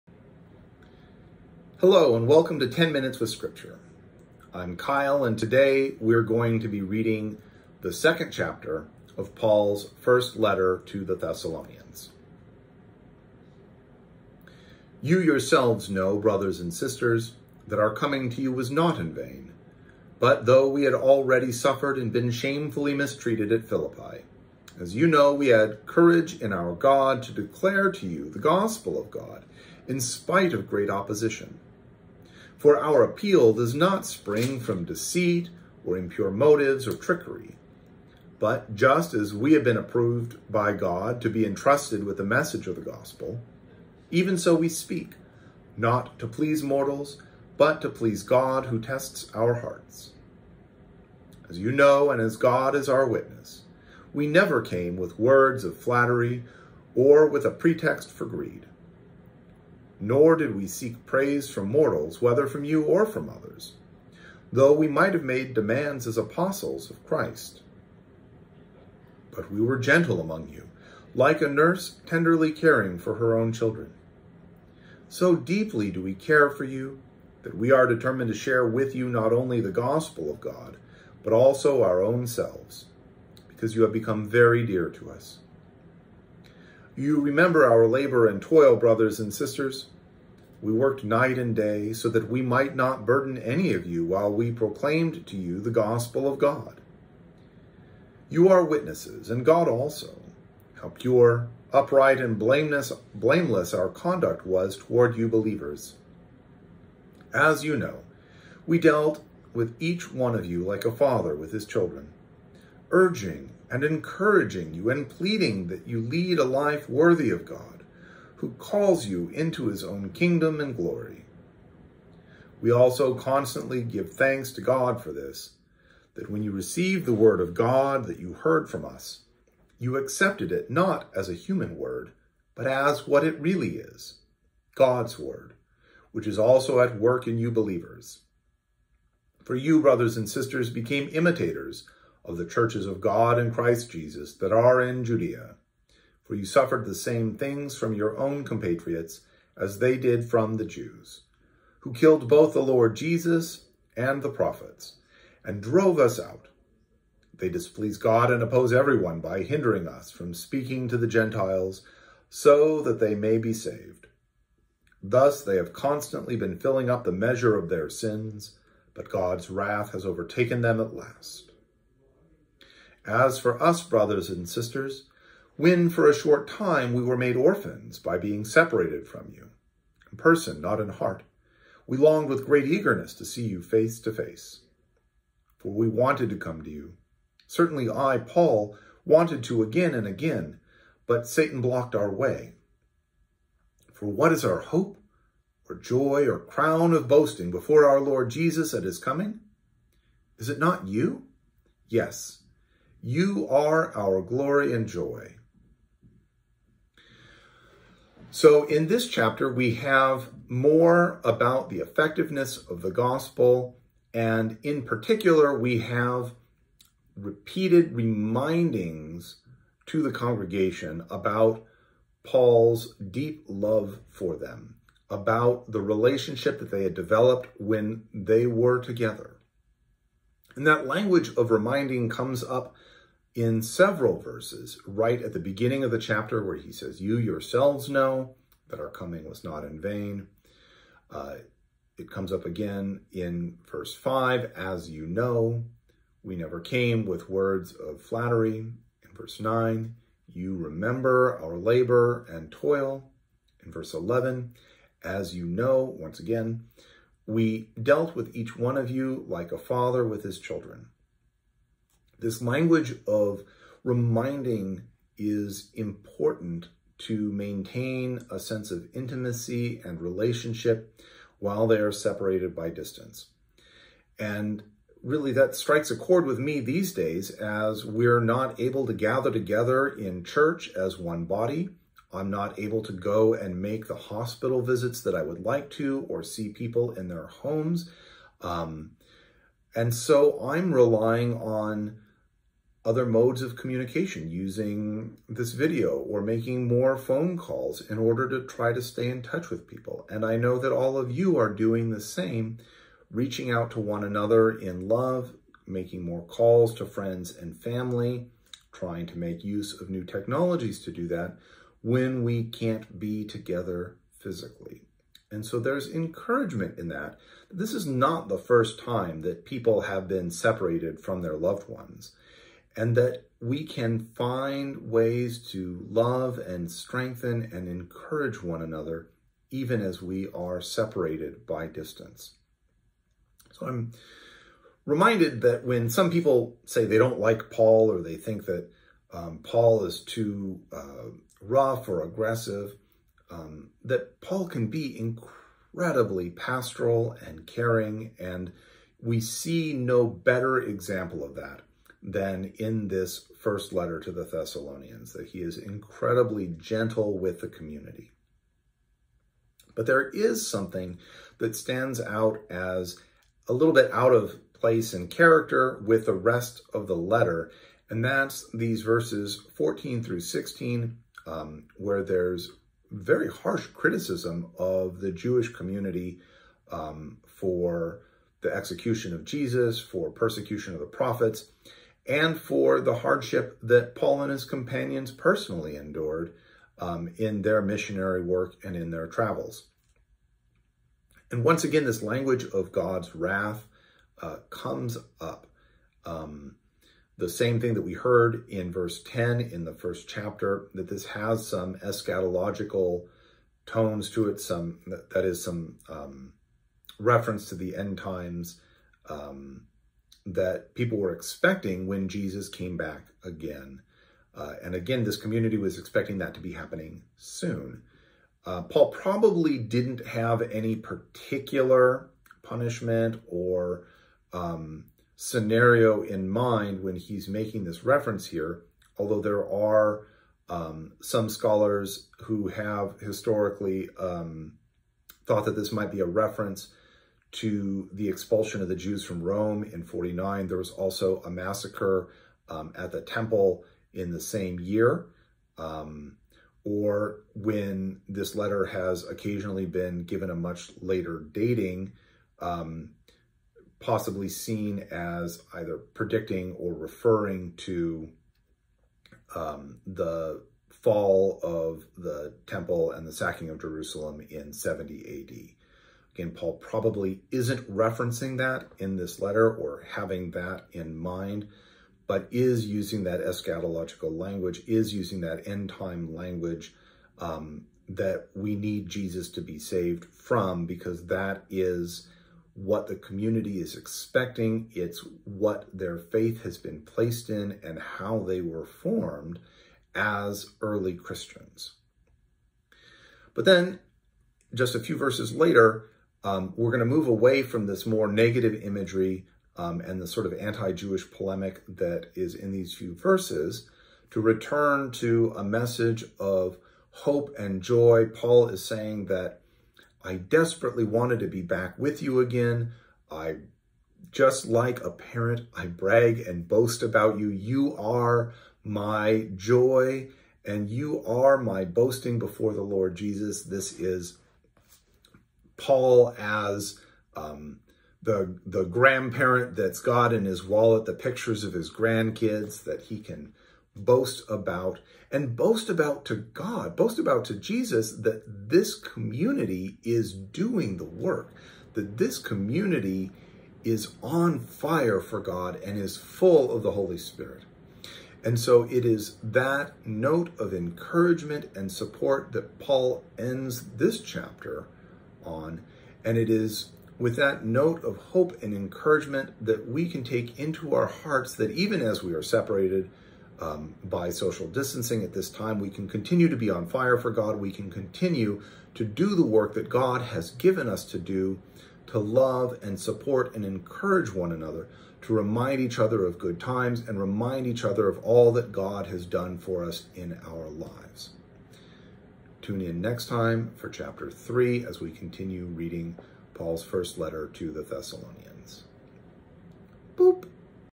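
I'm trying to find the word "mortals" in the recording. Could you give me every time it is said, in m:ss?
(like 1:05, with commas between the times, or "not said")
0:46, 1:01.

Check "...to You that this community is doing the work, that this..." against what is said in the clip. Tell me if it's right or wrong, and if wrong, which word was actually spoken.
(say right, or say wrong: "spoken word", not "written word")
wrong: "Jesus", not "You".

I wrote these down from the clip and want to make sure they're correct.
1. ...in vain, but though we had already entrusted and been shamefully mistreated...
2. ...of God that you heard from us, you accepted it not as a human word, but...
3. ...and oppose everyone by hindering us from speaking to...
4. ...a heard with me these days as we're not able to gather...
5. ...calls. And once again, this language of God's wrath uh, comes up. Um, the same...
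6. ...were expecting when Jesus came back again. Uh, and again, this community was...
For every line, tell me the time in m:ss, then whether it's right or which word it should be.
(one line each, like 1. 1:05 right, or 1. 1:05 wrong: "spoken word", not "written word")
1. 0:18 wrong: "suffered", not "entrusted"
2. 2:07 right
3. 2:38 right
4. 4:35 wrong: "chord", not "heard"
5. 6:29 wrong: "travels", not "calls"
6. 6:50 right.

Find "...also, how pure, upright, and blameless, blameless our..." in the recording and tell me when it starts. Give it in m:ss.
1:39.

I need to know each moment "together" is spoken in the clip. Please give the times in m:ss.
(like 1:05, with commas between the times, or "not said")
3:48, 4:39, 5:13.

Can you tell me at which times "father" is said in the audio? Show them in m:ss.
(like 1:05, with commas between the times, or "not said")
1:50, 4:19.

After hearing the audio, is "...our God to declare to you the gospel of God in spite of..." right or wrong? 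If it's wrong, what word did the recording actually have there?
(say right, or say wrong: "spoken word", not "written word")
right.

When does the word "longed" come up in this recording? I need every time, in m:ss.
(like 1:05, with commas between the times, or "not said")
3:01.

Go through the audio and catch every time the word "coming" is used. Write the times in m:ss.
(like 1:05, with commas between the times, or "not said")
0:17, 3:18, 3:58.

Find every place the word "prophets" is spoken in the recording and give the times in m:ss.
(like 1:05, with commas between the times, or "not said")
2:34, 6:20.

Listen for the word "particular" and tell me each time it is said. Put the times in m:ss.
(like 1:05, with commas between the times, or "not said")
3:34, 7:00.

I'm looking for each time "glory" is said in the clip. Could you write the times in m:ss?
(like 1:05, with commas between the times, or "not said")
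2:00, 3:24.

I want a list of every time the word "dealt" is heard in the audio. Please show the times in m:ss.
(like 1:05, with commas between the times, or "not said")
1:48, 4:17.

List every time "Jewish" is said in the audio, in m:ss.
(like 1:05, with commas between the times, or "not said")
6:15, 8:20.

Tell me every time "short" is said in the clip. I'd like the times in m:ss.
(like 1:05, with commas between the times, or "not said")
2:56.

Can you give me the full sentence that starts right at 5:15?
And so there's encouragement in that.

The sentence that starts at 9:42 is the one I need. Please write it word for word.
Tune in next time for chapter 3 as we continue reading Paul's first letter to the Thessalonians.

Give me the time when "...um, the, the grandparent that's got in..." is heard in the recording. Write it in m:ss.
8:47.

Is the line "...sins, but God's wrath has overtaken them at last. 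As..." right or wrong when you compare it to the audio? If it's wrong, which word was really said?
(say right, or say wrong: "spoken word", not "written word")
right.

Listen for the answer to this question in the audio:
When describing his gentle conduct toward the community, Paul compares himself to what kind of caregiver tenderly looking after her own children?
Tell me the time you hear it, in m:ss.
1:11.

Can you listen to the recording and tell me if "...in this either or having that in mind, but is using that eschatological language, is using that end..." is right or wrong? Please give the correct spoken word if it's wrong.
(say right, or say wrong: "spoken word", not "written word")
wrong: "letter", not "either".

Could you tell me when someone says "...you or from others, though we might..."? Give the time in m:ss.
1:02.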